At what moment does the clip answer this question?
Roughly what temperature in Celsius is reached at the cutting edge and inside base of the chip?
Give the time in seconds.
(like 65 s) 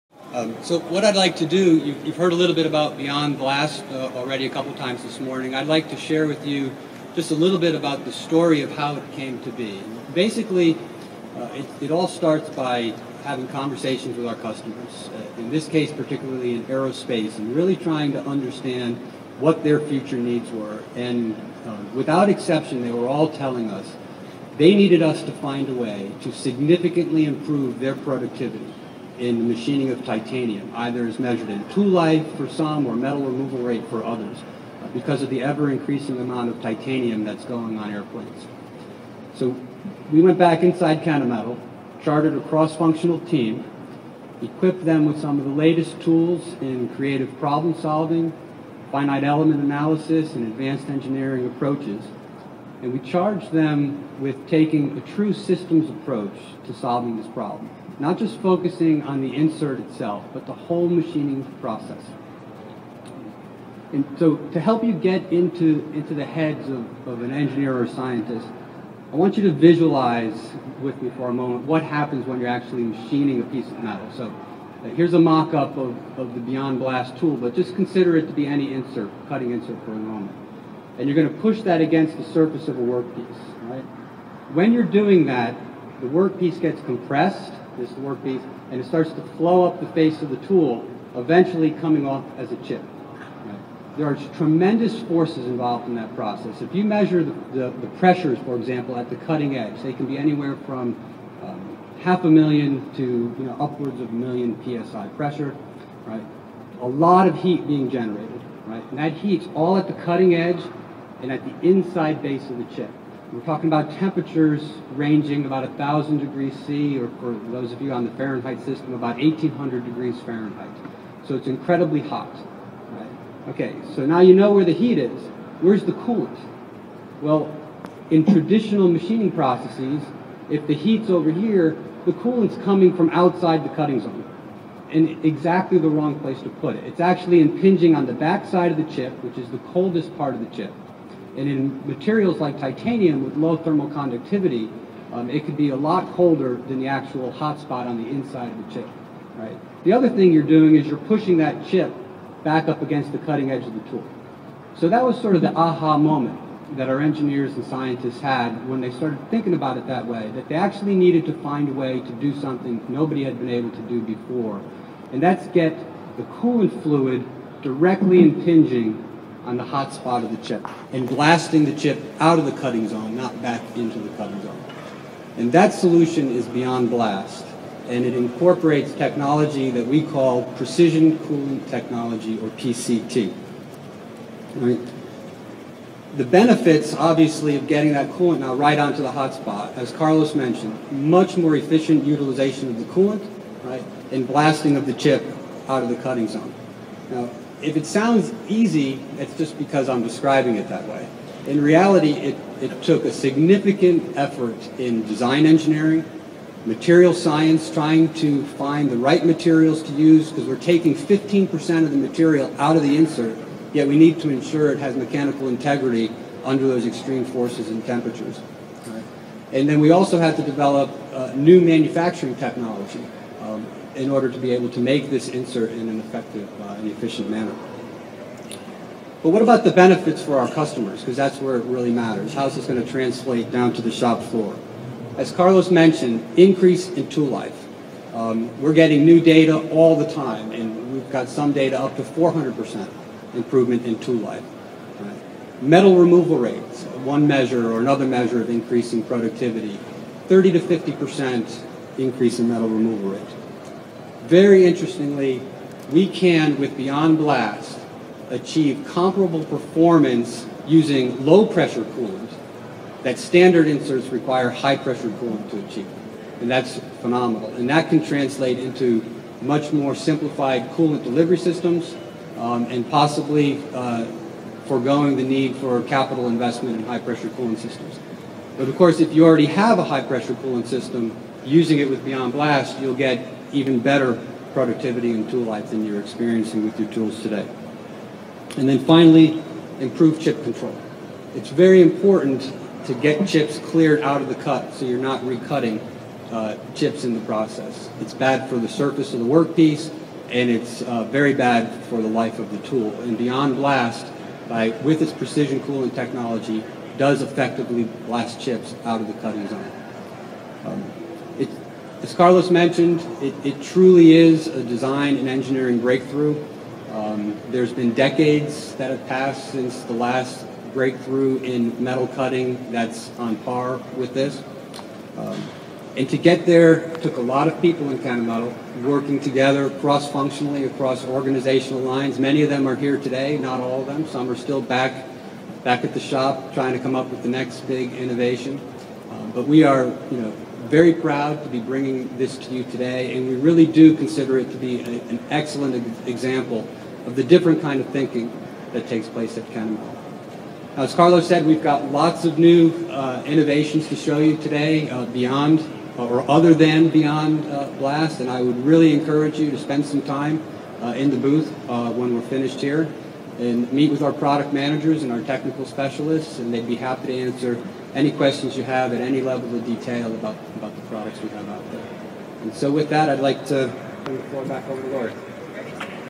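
115 s.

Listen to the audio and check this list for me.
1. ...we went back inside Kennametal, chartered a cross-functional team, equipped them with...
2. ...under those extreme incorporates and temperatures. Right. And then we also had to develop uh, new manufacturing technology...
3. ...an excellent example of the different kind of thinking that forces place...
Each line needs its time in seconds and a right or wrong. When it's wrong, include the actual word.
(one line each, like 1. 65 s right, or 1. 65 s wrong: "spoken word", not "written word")
1. 40 s right
2. 216 s wrong: "forces", not "incorporates"
3. 345 s wrong: "takes", not "forces".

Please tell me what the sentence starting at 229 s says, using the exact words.
But what about the benefits for our customers?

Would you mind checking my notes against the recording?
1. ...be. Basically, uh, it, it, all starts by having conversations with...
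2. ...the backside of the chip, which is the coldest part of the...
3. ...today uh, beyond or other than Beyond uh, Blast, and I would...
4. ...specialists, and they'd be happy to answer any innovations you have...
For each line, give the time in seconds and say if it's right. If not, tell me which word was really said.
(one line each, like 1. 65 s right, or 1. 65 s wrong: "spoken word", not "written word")
1. 9 s right
2. 138 s right
3. 354 s right
4. 365 s wrong: "questions", not "innovations".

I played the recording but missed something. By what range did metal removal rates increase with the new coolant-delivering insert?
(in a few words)
30 to 50%.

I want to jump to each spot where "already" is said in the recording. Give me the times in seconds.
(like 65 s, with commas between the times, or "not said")
4 s, 279 s.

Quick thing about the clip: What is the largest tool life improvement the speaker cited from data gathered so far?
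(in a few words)
400%.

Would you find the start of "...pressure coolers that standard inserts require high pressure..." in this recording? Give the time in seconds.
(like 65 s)
261 s.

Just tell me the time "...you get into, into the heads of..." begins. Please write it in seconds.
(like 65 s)
64 s.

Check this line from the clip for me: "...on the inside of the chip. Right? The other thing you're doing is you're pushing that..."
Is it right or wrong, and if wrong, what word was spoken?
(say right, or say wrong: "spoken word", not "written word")
right.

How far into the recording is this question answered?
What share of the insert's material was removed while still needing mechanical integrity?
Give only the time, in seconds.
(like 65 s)
210 s.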